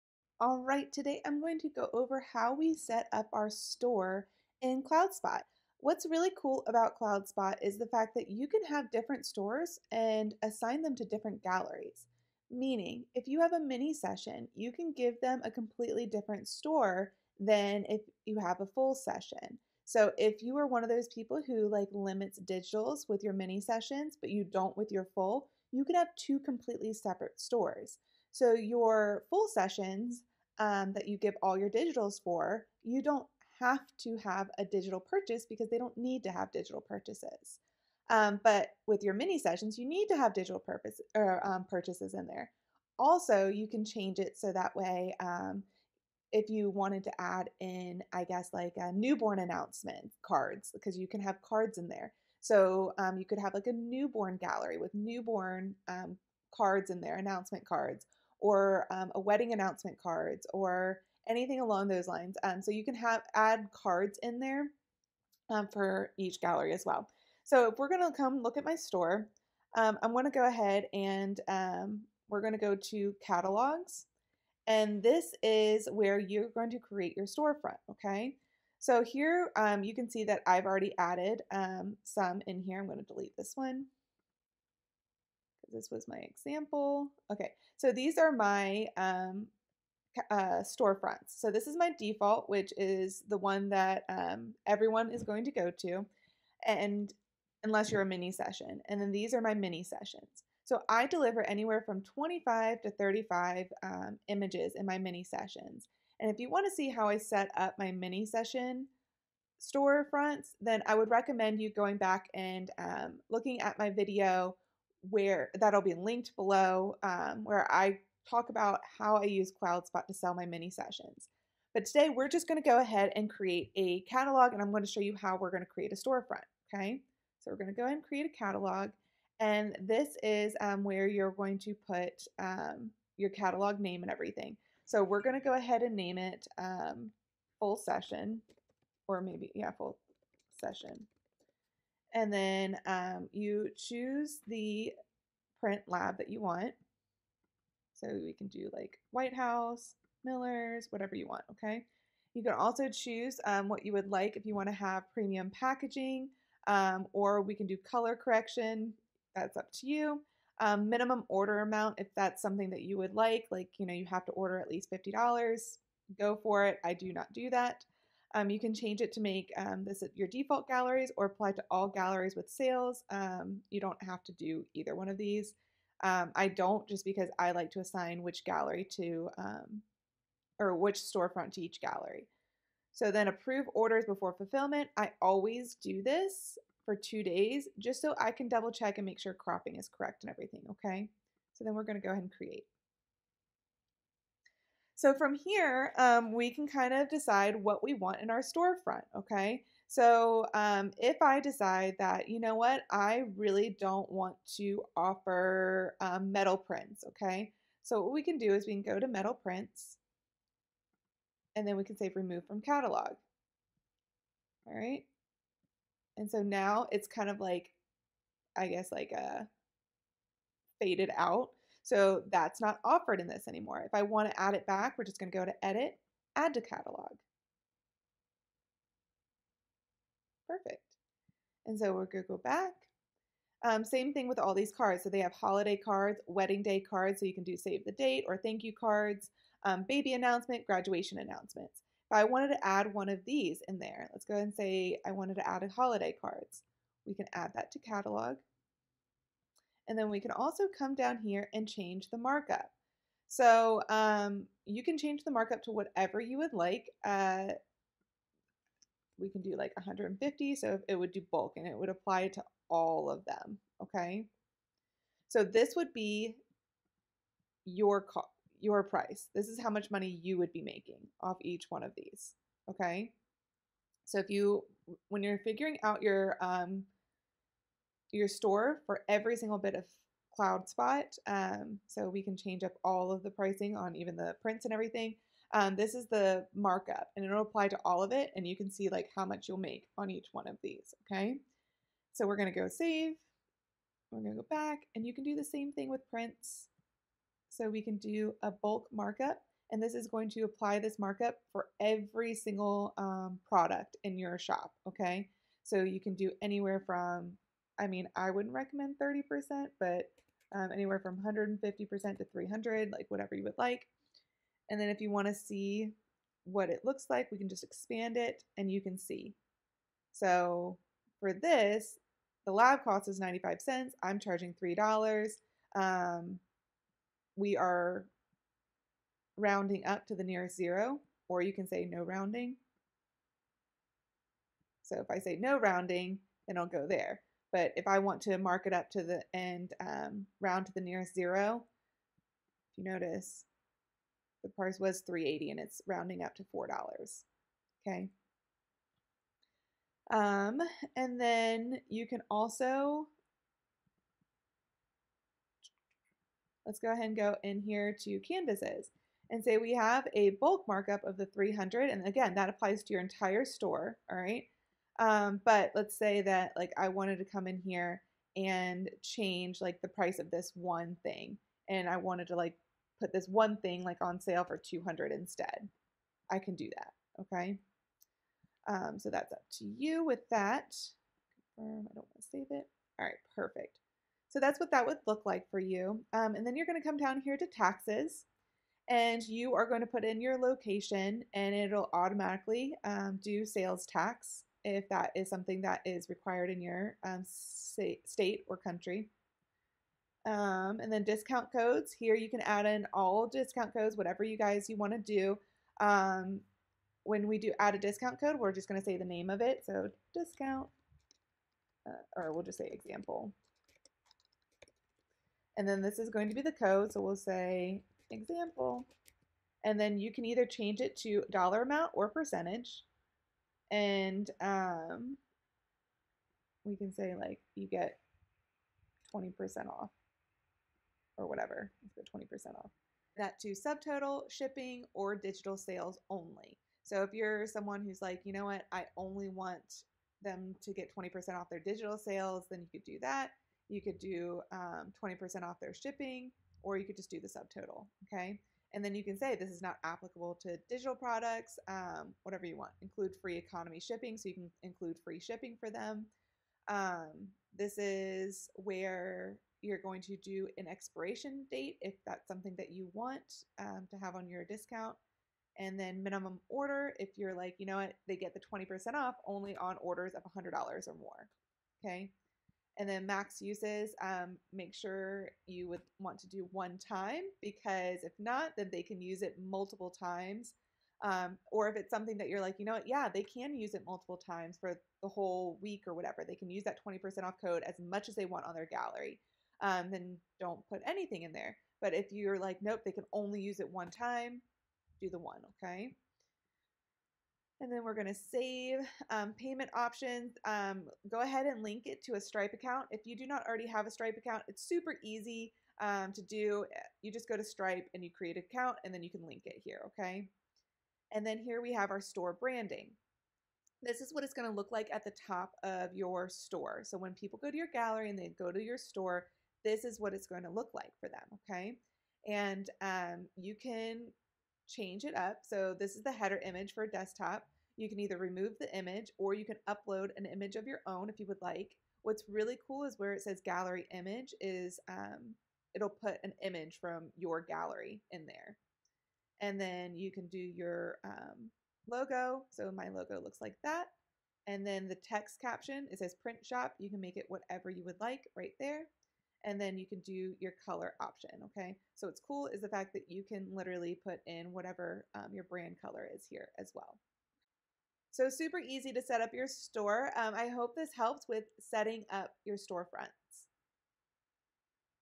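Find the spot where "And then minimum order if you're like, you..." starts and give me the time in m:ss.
7:45.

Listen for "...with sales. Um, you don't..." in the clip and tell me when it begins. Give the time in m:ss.
2:52.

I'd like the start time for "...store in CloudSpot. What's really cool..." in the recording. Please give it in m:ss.
0:03.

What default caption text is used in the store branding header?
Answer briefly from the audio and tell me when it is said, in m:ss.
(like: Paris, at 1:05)
print shop, at 9:06.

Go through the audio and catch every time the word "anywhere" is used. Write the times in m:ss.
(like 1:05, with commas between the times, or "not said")
1:41, 5:06, 5:10.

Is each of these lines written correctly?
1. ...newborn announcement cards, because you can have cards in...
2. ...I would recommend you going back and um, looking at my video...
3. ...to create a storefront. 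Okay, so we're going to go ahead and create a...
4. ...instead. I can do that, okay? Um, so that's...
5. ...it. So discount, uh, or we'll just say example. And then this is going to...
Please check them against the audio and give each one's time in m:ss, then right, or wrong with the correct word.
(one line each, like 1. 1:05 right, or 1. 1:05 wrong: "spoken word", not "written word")
1. 0:48 right
2. 1:50 right
3. 2:05 right
4. 6:15 right
5. 6:49 right.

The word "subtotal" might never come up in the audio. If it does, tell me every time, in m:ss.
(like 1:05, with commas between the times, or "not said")
7:13, 7:27.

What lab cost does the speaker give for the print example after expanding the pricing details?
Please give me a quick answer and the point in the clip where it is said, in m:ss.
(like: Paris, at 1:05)
95 cents, at 5:23.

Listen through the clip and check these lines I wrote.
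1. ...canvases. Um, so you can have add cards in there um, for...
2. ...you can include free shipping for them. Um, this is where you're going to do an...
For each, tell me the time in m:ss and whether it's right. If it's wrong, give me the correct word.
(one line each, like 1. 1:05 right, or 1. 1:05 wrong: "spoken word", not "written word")
1. 1:02 wrong: "lines", not "canvases"
2. 7:34 right.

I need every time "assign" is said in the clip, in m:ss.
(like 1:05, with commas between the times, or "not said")
0:10, 2:57.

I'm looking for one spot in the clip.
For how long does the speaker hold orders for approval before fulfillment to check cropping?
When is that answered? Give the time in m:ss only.
3:06.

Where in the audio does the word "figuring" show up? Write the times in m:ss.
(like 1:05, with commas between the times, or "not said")
4:35.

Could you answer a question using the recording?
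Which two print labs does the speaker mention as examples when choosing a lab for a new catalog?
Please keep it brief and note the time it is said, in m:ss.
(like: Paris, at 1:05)
White House, Miller's, at 2:29.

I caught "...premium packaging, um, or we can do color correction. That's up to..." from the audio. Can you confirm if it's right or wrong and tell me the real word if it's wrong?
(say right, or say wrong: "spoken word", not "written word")
right.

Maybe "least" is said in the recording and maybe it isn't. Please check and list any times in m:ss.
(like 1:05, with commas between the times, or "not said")
2:44.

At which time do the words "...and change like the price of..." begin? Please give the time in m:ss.
6:08.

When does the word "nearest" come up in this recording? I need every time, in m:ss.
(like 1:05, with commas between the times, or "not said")
5:30, 5:40.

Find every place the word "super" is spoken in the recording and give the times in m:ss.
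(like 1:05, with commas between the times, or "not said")
8:24, 9:18.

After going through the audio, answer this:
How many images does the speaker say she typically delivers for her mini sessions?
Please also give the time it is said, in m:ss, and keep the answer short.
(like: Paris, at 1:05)
25 to 35, at 1:42.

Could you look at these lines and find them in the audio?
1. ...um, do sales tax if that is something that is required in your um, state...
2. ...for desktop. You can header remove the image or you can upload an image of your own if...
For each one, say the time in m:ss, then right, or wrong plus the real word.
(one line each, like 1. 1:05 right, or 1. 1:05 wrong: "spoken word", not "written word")
1. 6:32 right
2. 8:46 wrong: "either", not "header".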